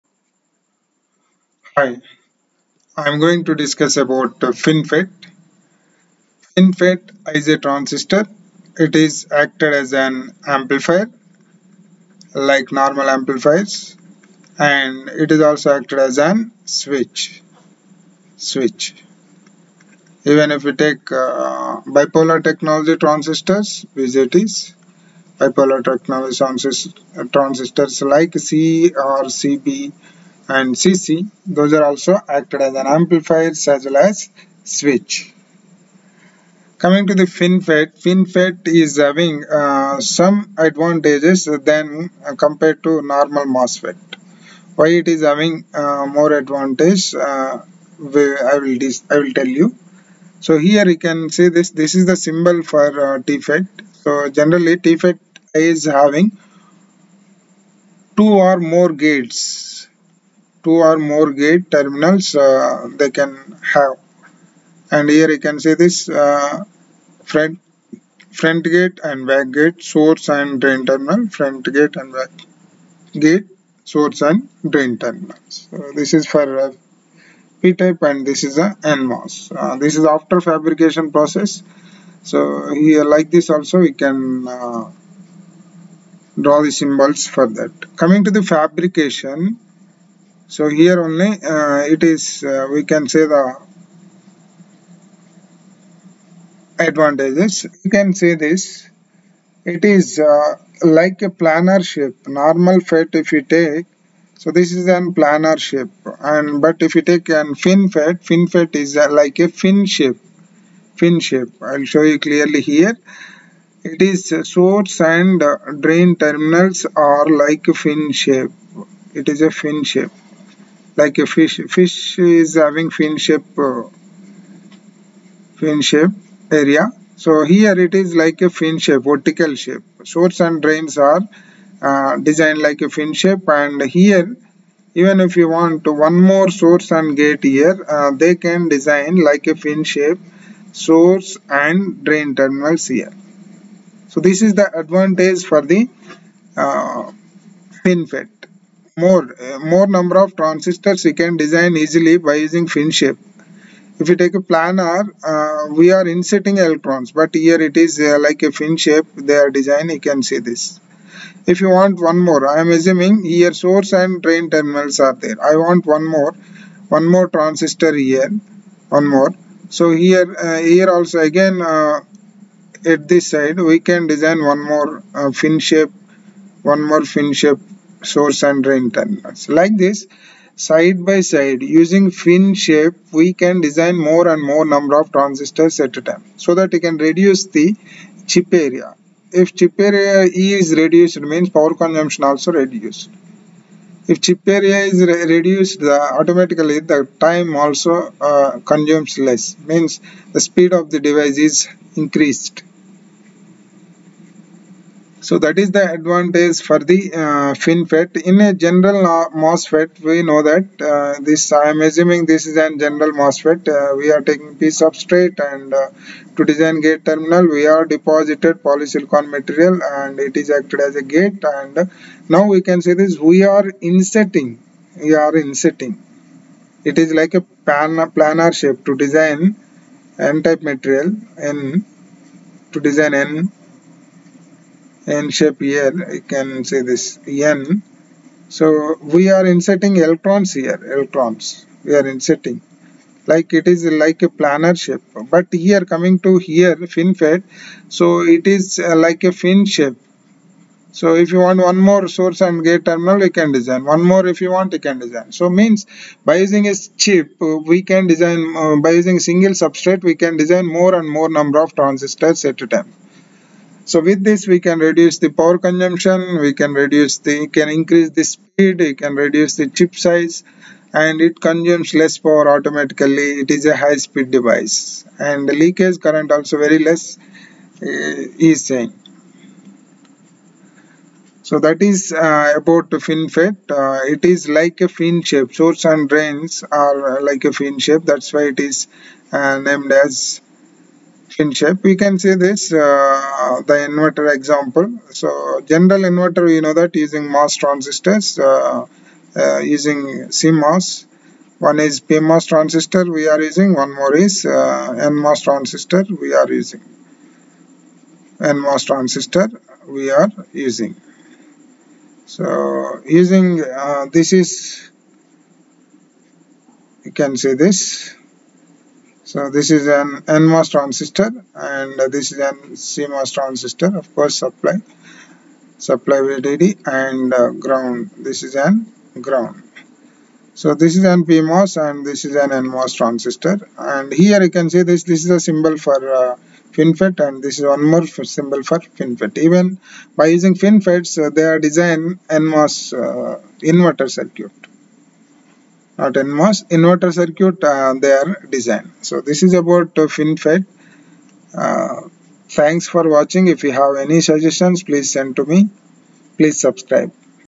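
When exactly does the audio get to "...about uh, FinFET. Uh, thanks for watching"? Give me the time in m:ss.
5:49.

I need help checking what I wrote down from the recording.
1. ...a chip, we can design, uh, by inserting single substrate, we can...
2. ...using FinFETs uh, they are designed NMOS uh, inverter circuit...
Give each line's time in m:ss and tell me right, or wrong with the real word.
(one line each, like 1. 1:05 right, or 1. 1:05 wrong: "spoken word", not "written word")
1. 4:16 wrong: "using", not "inserting"
2. 5:40 right.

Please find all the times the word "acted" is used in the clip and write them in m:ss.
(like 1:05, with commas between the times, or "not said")
0:09, 0:15, 0:32, 3:40.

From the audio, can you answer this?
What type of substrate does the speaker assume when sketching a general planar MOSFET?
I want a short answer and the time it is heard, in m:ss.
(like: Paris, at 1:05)
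P substrate, at 3:34.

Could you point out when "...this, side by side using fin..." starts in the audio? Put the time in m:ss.
2:59.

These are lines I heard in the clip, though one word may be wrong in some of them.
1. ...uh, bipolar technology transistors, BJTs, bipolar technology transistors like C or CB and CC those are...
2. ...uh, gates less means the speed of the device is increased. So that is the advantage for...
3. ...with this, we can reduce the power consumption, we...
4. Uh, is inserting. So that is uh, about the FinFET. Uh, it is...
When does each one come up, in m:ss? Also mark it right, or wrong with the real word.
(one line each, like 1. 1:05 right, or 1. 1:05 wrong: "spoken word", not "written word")
1. 0:21 right
2. 3:18 wrong: "consumes", not "gates"
3. 4:23 right
4. 4:37 wrong: "saying", not "inserting".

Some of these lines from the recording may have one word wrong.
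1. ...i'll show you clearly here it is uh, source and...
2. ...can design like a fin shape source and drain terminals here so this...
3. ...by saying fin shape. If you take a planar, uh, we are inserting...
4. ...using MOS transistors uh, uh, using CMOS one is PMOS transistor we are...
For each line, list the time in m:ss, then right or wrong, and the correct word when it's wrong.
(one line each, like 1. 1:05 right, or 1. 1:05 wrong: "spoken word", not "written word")
1. 1:51 right
2. 2:18 right
3. 2:32 wrong: "using", not "saying"
4. 4:57 right.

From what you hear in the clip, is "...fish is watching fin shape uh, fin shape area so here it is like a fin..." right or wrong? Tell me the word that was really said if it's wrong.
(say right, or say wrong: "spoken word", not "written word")
wrong: "having", not "watching".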